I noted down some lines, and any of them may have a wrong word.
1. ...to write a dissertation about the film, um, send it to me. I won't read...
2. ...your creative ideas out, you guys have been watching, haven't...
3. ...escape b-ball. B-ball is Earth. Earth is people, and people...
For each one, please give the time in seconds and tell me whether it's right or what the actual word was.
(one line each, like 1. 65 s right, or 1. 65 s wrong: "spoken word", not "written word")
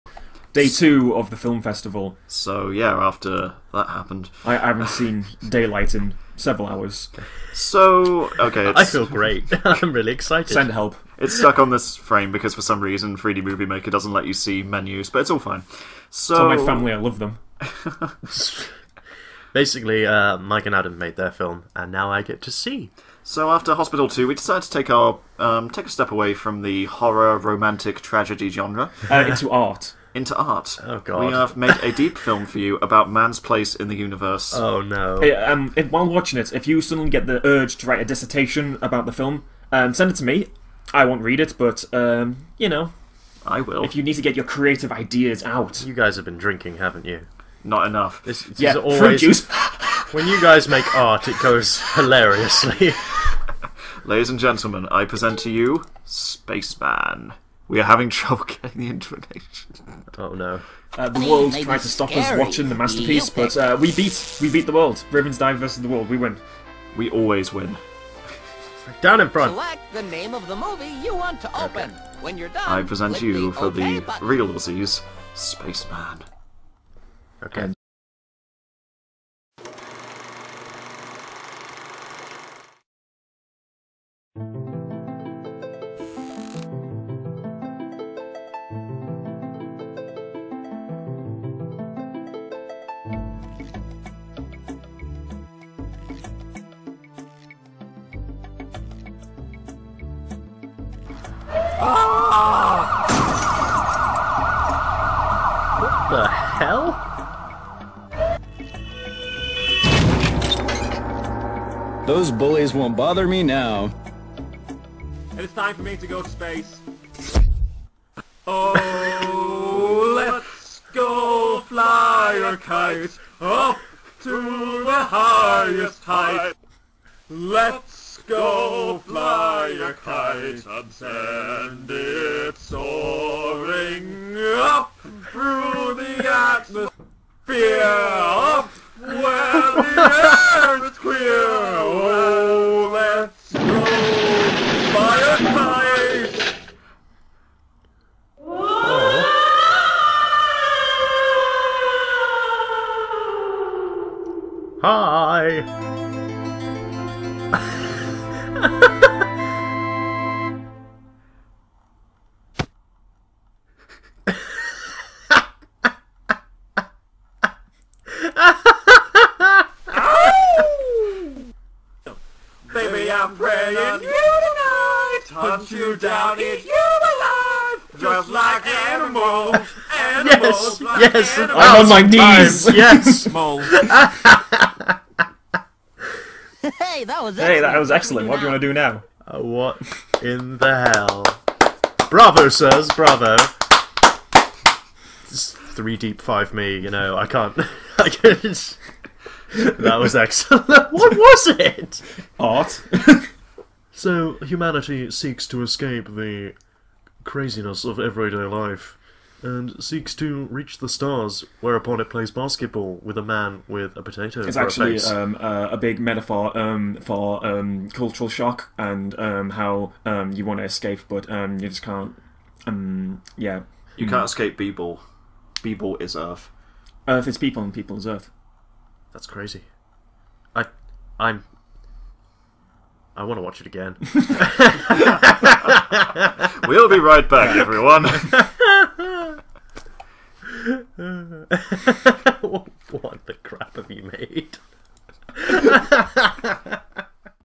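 1. 37 s right
2. 44 s wrong: "drinking", not "watching"
3. 224 s right.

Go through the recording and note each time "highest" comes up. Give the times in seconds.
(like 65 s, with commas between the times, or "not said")
125 s.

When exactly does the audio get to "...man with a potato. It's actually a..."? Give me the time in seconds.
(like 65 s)
213 s.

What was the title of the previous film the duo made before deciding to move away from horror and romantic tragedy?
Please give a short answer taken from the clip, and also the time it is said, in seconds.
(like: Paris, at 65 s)
Hospital 2, at 23 s.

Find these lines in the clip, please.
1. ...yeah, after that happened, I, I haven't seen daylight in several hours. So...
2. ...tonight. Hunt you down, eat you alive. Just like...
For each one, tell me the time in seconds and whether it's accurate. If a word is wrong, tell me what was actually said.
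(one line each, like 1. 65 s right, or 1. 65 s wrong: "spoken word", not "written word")
1. 2 s right
2. 174 s right.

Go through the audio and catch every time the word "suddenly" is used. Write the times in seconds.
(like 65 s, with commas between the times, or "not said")
36 s.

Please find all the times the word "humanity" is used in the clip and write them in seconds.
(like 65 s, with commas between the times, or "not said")
204 s.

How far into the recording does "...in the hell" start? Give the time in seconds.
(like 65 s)
190 s.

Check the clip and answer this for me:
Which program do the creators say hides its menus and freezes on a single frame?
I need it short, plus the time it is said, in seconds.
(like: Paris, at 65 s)
3D Movie Maker, at 13 s.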